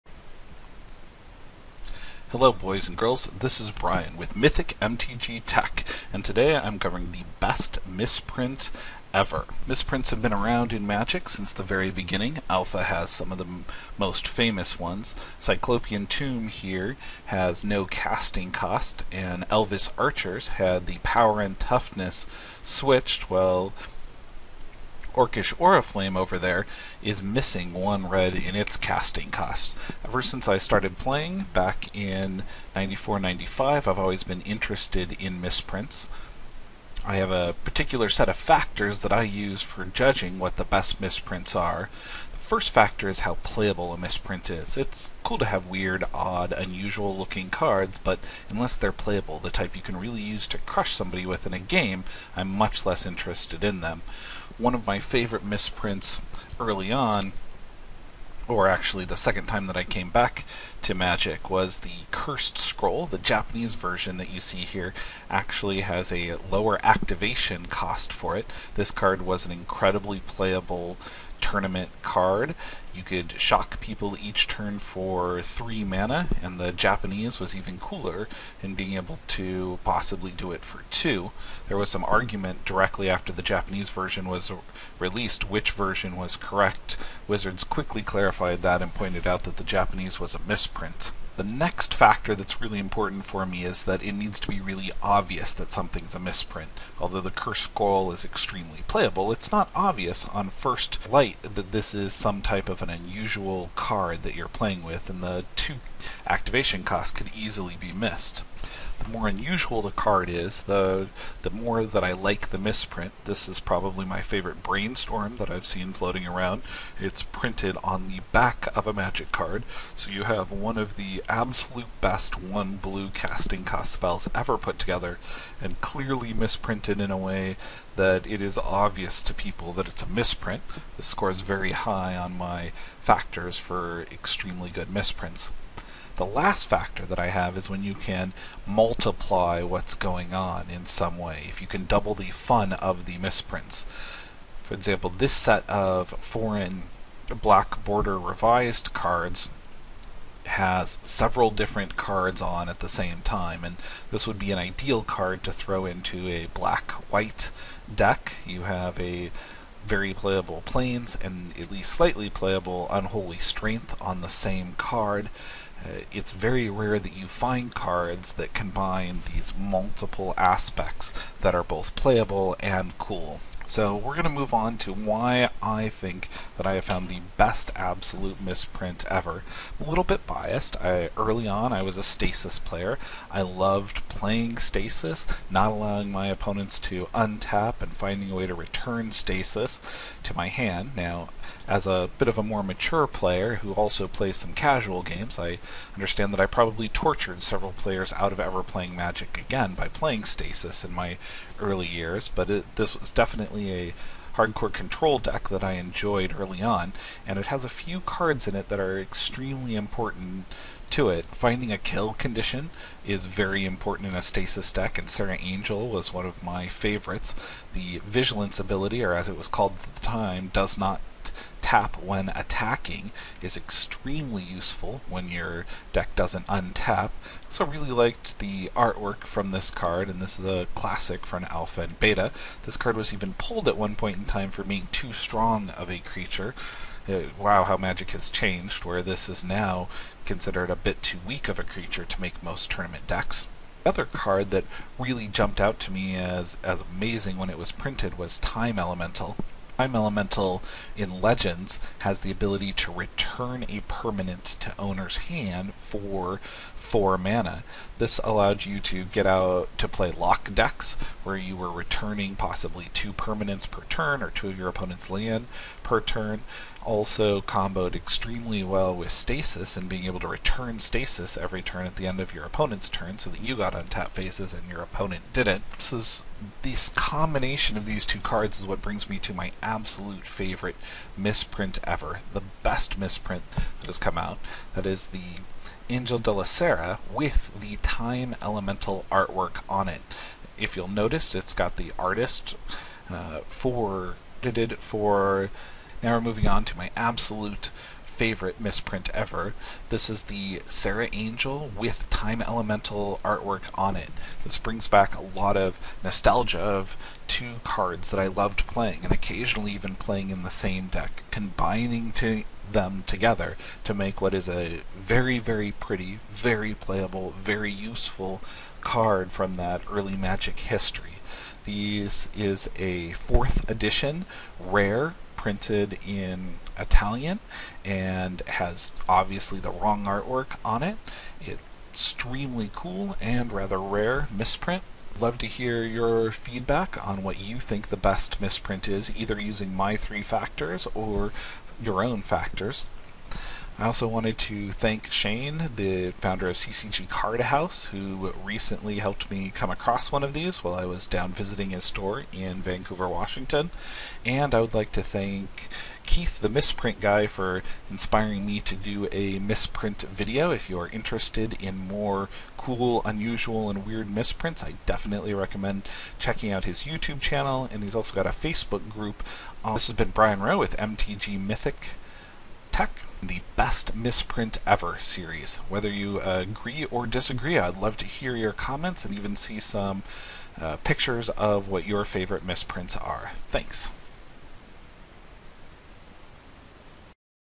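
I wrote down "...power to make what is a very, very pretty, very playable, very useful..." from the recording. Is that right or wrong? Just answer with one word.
wrong.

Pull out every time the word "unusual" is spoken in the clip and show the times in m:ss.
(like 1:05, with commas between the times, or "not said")
0:46, 1:42, 1:49, 6:03.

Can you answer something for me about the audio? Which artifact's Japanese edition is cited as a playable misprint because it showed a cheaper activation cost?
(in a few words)
Cursed Scroll.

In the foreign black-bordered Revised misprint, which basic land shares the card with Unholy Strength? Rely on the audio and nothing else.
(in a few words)
Plains.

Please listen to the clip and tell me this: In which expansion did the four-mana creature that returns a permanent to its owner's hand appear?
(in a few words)
Legends.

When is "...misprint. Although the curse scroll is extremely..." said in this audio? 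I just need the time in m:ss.
1:36.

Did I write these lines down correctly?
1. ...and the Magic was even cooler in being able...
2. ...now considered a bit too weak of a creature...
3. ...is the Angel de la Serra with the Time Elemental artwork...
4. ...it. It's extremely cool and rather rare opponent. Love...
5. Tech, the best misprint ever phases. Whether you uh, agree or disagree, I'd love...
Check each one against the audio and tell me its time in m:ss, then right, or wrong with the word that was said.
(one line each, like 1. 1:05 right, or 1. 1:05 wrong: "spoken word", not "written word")
1. 1:16 wrong: "Japanese", not "Magic"
2. 3:59 right
3. 4:44 right
4. 5:30 wrong: "misprint", not "opponent"
5. 6:12 wrong: "series", not "phases".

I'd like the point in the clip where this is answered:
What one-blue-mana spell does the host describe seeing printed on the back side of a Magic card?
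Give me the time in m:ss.
1:54.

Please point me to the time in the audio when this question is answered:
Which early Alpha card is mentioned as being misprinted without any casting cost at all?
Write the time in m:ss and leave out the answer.
0:15.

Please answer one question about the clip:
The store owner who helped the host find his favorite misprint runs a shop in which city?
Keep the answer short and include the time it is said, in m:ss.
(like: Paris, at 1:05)
Vancouver, Washington, at 5:52.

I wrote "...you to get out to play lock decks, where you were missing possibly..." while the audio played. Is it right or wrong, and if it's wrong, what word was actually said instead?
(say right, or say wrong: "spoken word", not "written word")
wrong: "returning", not "missing".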